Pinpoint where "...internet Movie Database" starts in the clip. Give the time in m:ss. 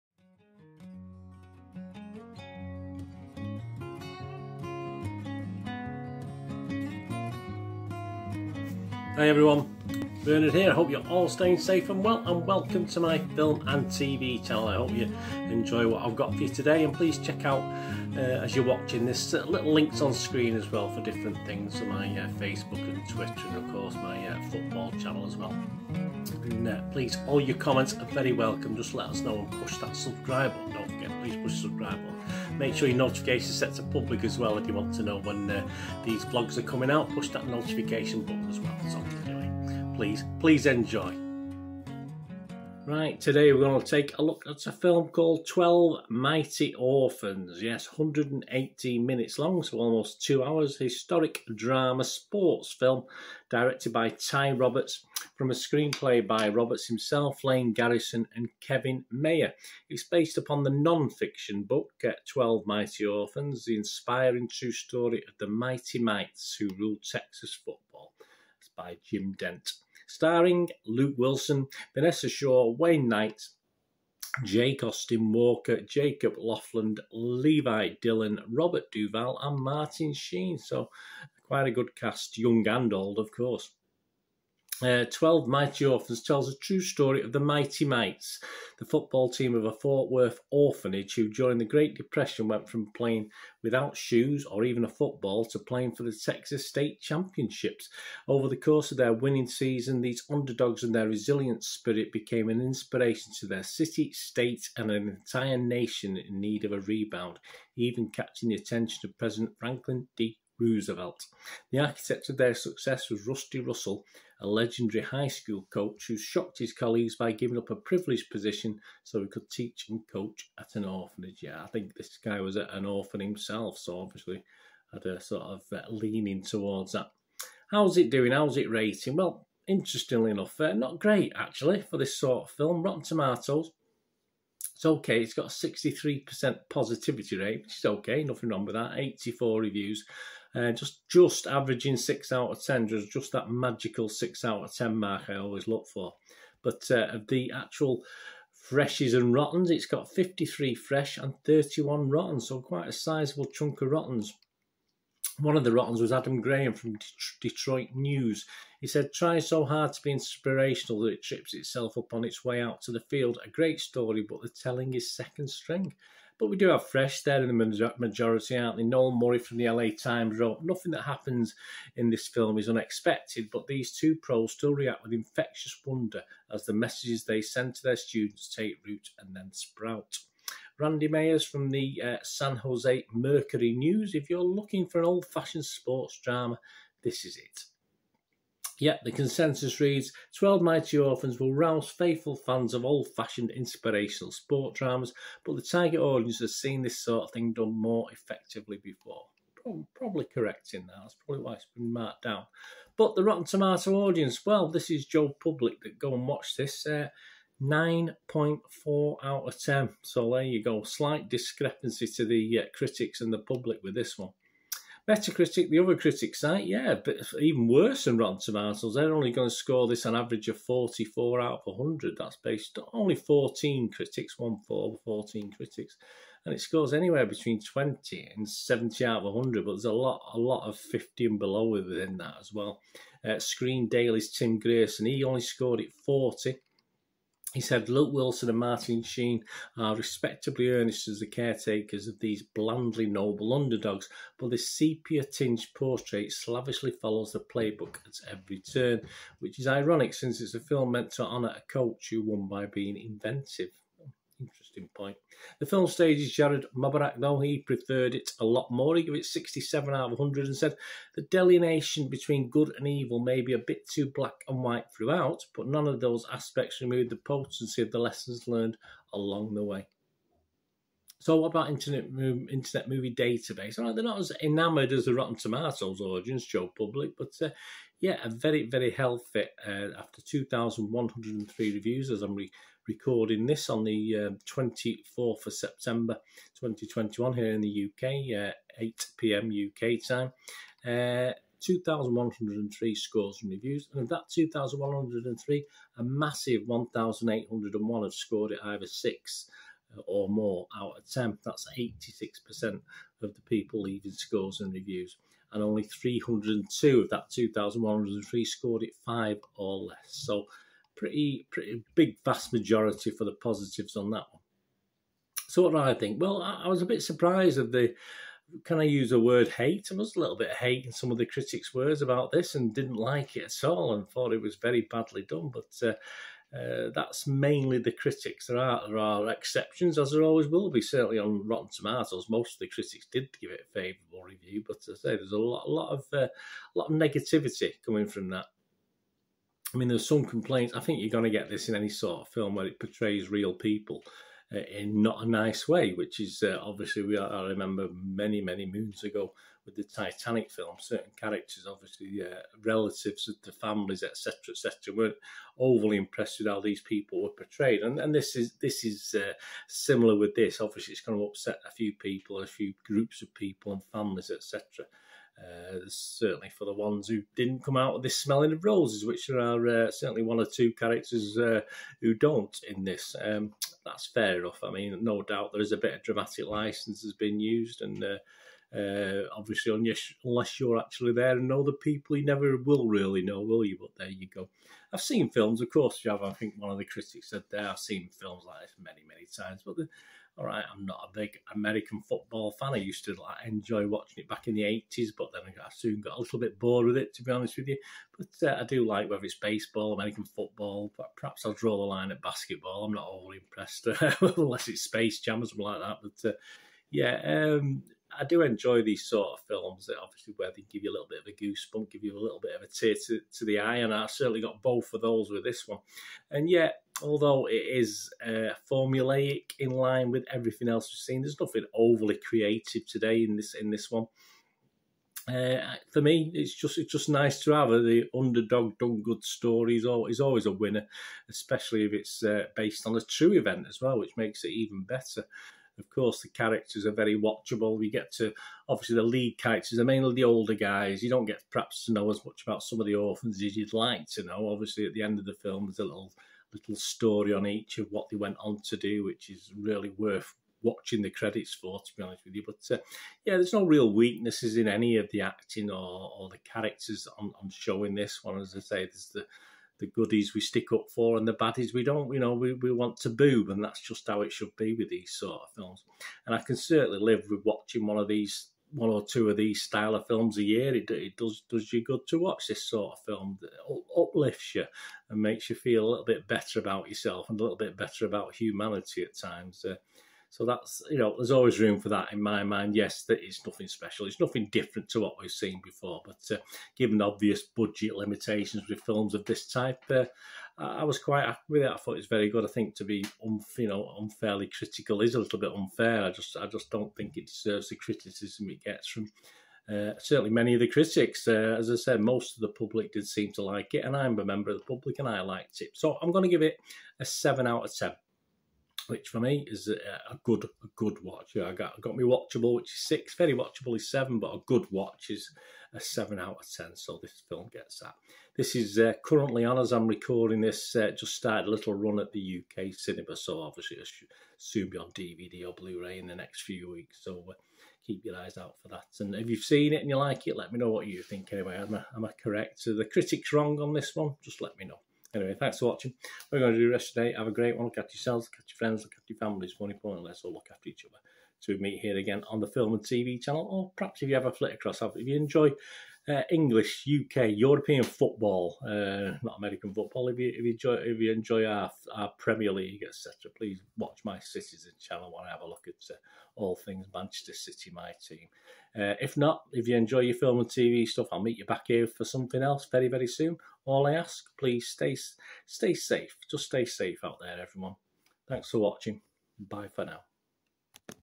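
4:32.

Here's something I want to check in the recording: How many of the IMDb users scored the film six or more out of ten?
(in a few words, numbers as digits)
1,801.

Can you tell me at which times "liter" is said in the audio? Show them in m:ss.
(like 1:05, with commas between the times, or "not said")
not said.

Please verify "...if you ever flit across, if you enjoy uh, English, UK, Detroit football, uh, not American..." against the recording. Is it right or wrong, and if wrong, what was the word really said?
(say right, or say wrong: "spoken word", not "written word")
wrong: "European", not "Detroit".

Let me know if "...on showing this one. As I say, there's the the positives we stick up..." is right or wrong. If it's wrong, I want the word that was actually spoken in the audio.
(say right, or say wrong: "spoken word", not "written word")
wrong: "goodies", not "positives".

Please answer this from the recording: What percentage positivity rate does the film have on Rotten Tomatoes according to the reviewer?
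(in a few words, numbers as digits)
63%.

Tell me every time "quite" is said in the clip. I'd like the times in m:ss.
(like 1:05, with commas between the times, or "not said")
1:21, 2:32, 8:10.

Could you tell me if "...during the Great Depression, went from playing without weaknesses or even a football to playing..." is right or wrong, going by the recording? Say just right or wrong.
wrong.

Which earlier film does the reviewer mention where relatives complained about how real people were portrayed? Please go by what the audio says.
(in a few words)
Titanic.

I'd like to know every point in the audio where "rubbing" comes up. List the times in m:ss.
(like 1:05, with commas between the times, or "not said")
not said.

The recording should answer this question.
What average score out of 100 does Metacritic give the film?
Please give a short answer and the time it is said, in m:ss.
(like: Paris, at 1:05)
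44, at 3:40.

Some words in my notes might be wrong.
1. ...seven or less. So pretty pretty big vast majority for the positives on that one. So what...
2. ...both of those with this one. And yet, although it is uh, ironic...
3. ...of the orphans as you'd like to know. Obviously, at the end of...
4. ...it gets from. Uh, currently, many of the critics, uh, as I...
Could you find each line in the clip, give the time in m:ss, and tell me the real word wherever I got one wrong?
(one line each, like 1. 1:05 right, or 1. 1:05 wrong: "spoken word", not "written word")
1. 5:09 wrong: "five", not "seven"
2. 6:54 wrong: "formulaic", not "ironic"
3. 7:22 right
4. 8:18 wrong: "certainly", not "currently".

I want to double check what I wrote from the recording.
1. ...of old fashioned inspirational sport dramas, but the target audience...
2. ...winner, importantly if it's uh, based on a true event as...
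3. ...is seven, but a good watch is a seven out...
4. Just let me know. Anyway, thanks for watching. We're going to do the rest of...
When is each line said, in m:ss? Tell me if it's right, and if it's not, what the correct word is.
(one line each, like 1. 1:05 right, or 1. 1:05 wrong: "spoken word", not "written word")
1. 3:12 right
2. 7:10 wrong: "especially", not "importantly"
3. 8:33 right
4. 8:54 right.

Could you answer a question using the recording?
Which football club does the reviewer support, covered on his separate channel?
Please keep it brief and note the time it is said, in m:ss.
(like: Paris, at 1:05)
Manchester City, at 9:16.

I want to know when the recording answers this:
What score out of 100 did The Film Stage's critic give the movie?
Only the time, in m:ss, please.
4:19.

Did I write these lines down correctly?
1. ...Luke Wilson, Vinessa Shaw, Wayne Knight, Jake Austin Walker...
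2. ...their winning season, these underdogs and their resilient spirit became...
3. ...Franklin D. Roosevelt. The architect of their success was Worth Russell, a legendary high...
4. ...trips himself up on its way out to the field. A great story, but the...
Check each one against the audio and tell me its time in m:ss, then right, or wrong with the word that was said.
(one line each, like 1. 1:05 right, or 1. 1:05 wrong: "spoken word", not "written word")
1. 1:10 right
2. 1:38 right
3. 1:49 wrong: "Rusty", not "Worth"
4. 2:41 wrong: "itself", not "himself".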